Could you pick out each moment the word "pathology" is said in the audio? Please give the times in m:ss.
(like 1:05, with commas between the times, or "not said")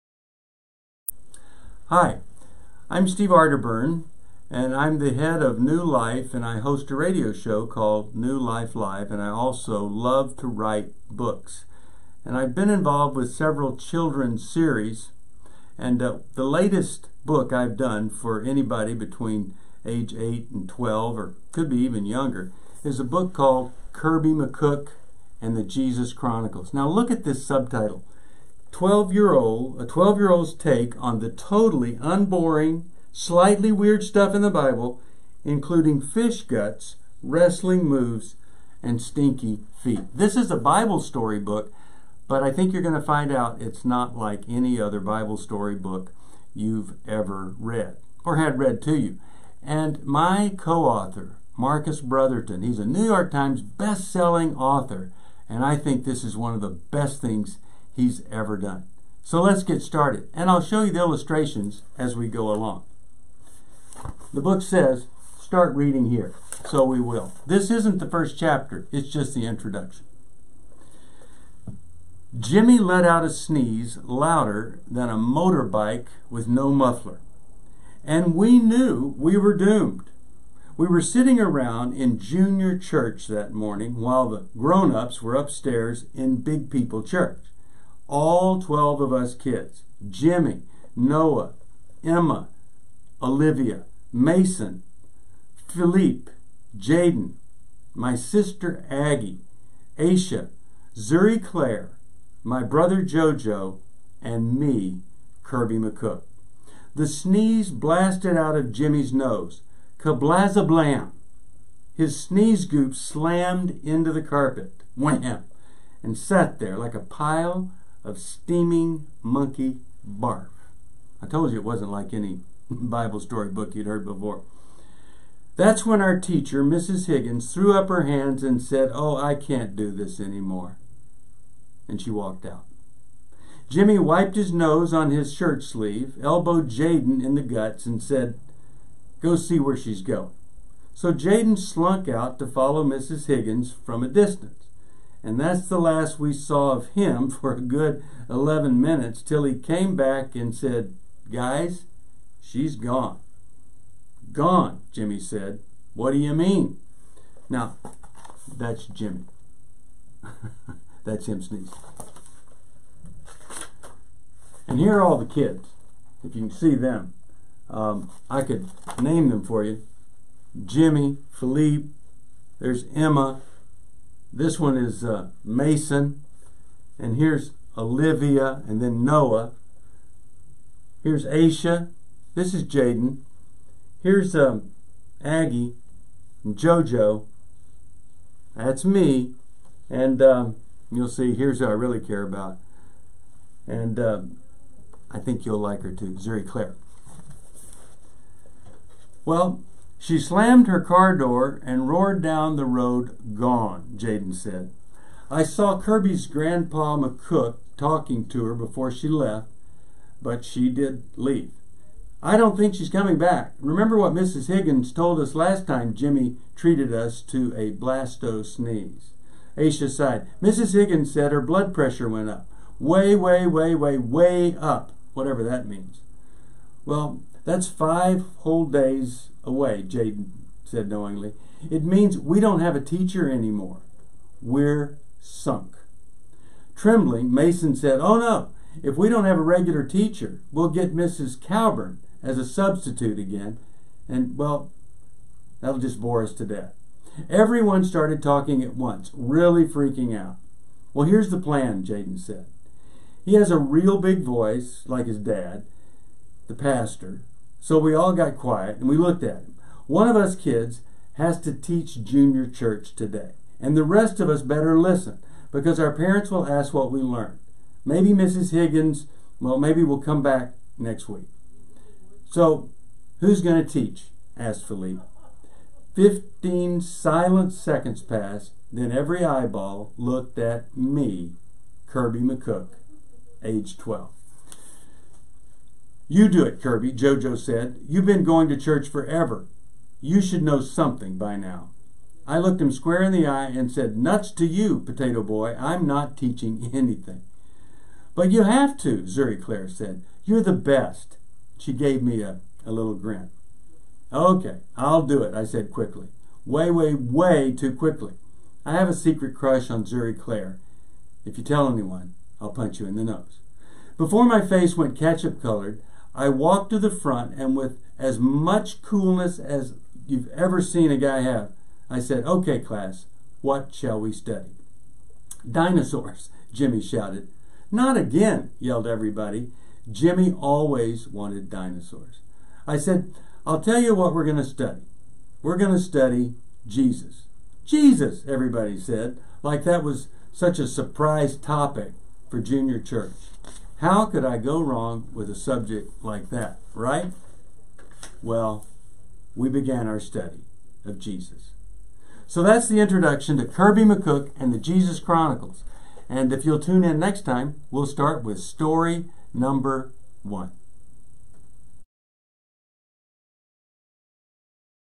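not said.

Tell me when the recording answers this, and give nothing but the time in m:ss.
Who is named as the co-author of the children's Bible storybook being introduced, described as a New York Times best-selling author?
0:51.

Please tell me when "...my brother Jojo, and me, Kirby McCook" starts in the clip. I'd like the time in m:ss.
1:42.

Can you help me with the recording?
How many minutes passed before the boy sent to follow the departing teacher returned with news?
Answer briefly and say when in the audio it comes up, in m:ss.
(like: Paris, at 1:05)
11, at 2:28.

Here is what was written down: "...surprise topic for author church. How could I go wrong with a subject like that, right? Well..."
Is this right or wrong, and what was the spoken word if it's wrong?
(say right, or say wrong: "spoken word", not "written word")
wrong: "junior", not "author".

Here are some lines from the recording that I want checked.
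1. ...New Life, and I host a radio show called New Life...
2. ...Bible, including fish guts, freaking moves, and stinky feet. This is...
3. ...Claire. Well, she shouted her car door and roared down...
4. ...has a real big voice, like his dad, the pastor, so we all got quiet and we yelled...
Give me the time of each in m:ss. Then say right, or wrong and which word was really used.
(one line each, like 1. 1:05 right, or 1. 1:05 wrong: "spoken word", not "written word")
1. 0:05 right
2. 0:34 wrong: "wrestling", not "freaking"
3. 3:16 wrong: "slammed", not "shouted"
4. 4:13 wrong: "looked", not "yelled".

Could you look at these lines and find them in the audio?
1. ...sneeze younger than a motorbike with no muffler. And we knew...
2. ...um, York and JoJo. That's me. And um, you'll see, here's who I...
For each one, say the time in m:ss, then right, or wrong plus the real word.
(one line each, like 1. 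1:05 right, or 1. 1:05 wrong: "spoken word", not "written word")
1. 1:13 wrong: "louder", not "younger"
2. 3:04 wrong: "Aggie", not "York".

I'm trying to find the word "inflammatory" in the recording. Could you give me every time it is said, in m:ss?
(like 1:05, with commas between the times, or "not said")
not said.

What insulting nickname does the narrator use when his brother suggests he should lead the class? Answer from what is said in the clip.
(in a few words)
Potato Boy.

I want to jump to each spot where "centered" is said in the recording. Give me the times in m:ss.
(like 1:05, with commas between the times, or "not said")
not said.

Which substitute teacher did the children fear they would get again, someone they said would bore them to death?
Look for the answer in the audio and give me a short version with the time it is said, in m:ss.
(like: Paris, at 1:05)
Mrs. Cowburn, at 4:00.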